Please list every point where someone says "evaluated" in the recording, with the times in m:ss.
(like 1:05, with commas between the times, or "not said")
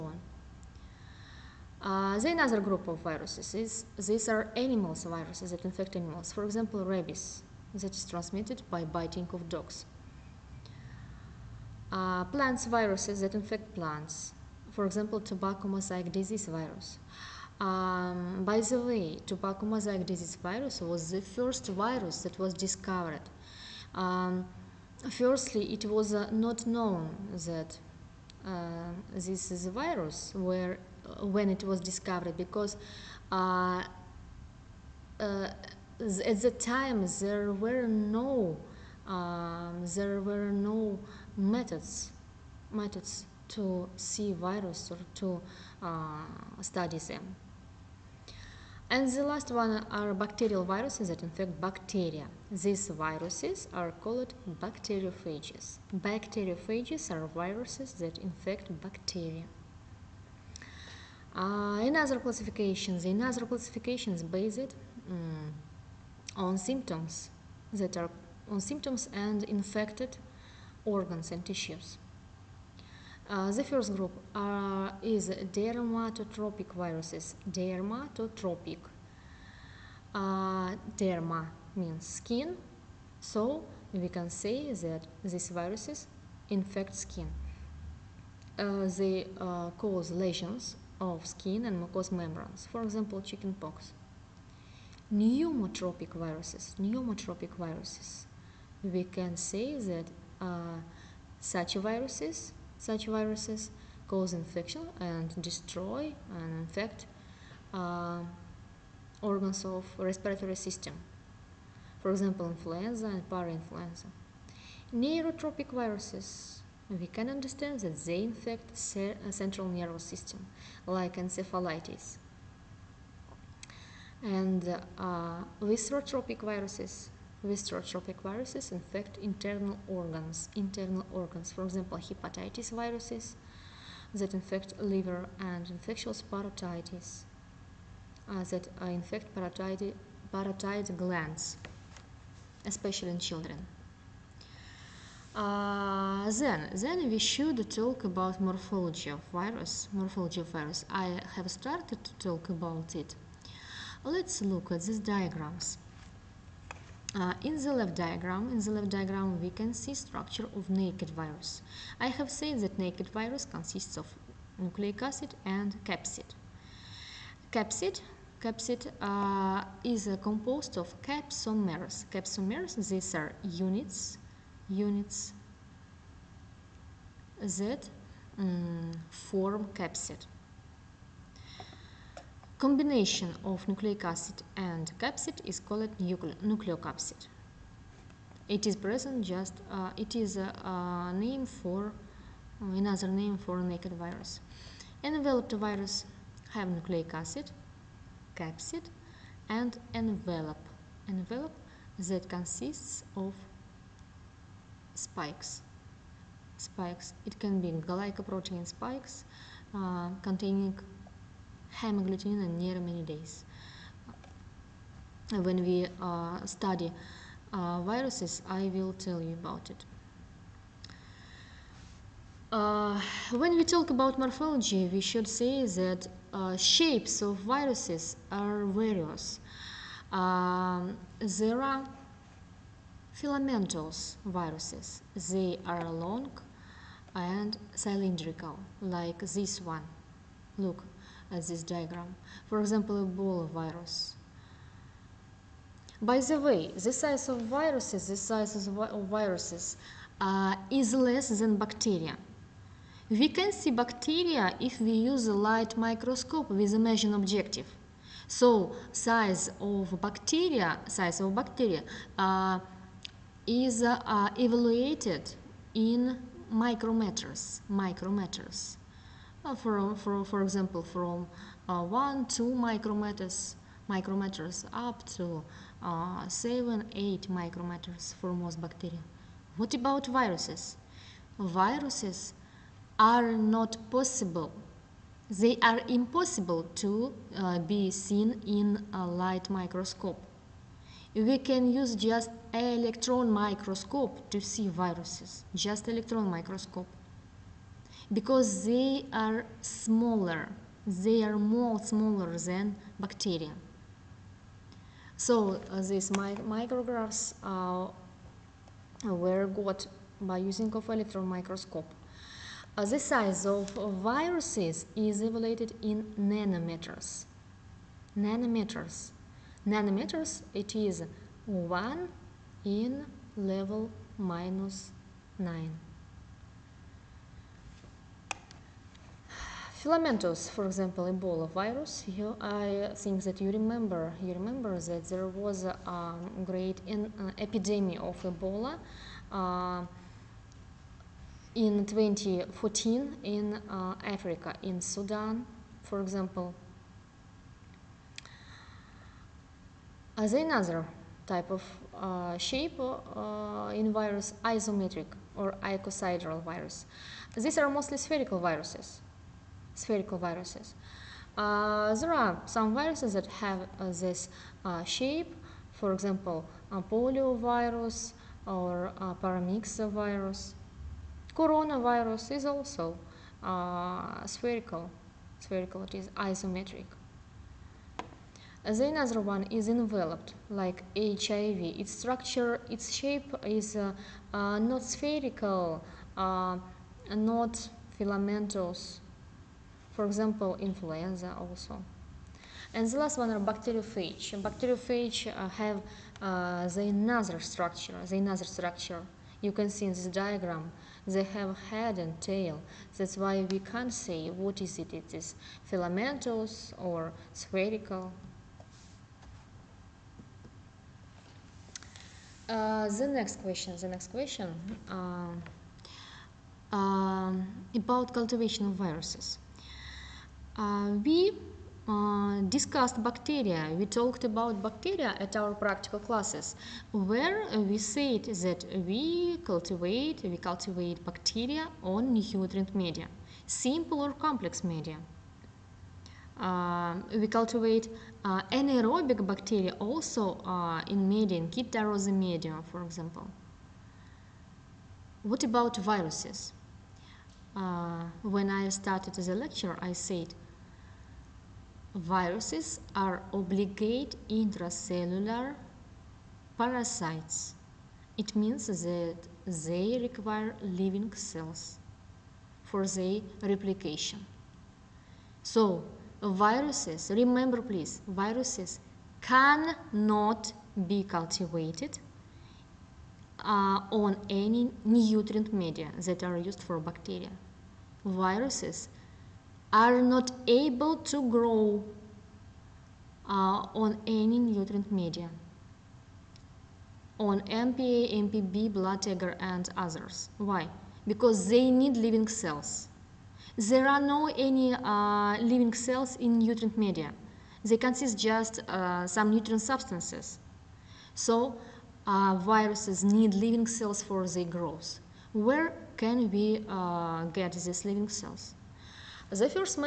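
4:24, 5:15.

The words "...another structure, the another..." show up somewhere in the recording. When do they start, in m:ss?
6:36.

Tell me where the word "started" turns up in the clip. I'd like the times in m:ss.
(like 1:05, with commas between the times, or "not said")
2:31, 7:28.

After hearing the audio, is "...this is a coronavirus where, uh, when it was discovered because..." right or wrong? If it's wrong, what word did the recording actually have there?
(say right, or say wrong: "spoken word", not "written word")
wrong: "virus", not "coronavirus".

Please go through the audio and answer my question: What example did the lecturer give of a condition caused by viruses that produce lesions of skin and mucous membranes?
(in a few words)
Chickenpox.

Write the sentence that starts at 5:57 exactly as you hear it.
These are mostly spherical viruses spherical viruses.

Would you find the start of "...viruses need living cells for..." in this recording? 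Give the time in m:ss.
8:22.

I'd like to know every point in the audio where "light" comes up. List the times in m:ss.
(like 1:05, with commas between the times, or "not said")
4:15, 4:49.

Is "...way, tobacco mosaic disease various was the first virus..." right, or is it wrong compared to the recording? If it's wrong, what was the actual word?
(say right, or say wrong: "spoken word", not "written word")
wrong: "virus", not "various".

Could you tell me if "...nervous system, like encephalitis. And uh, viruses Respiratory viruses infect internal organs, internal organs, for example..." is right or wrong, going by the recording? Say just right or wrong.
right.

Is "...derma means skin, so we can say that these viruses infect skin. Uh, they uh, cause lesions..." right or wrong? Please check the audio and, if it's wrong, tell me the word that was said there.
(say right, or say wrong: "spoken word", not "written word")
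right.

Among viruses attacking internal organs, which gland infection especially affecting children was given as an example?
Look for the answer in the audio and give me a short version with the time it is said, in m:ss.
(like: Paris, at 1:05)
Infectious parotitis, at 2:15.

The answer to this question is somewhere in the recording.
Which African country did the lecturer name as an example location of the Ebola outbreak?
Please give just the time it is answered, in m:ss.
5:44.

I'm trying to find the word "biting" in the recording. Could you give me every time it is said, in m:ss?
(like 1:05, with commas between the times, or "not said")
0:08.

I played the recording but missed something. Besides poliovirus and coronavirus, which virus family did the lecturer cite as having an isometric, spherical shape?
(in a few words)
Paramyxovirus.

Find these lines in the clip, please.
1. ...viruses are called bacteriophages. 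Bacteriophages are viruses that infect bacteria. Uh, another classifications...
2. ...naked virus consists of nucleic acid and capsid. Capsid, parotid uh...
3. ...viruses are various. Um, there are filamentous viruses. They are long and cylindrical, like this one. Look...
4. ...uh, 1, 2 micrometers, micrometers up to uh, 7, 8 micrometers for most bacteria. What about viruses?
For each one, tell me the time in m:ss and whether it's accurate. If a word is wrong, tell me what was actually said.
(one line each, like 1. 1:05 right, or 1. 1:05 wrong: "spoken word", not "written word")
1. 0:52 right
2. 2:42 wrong: "capsid", not "parotid"
3. 3:47 right
4. 4:31 right.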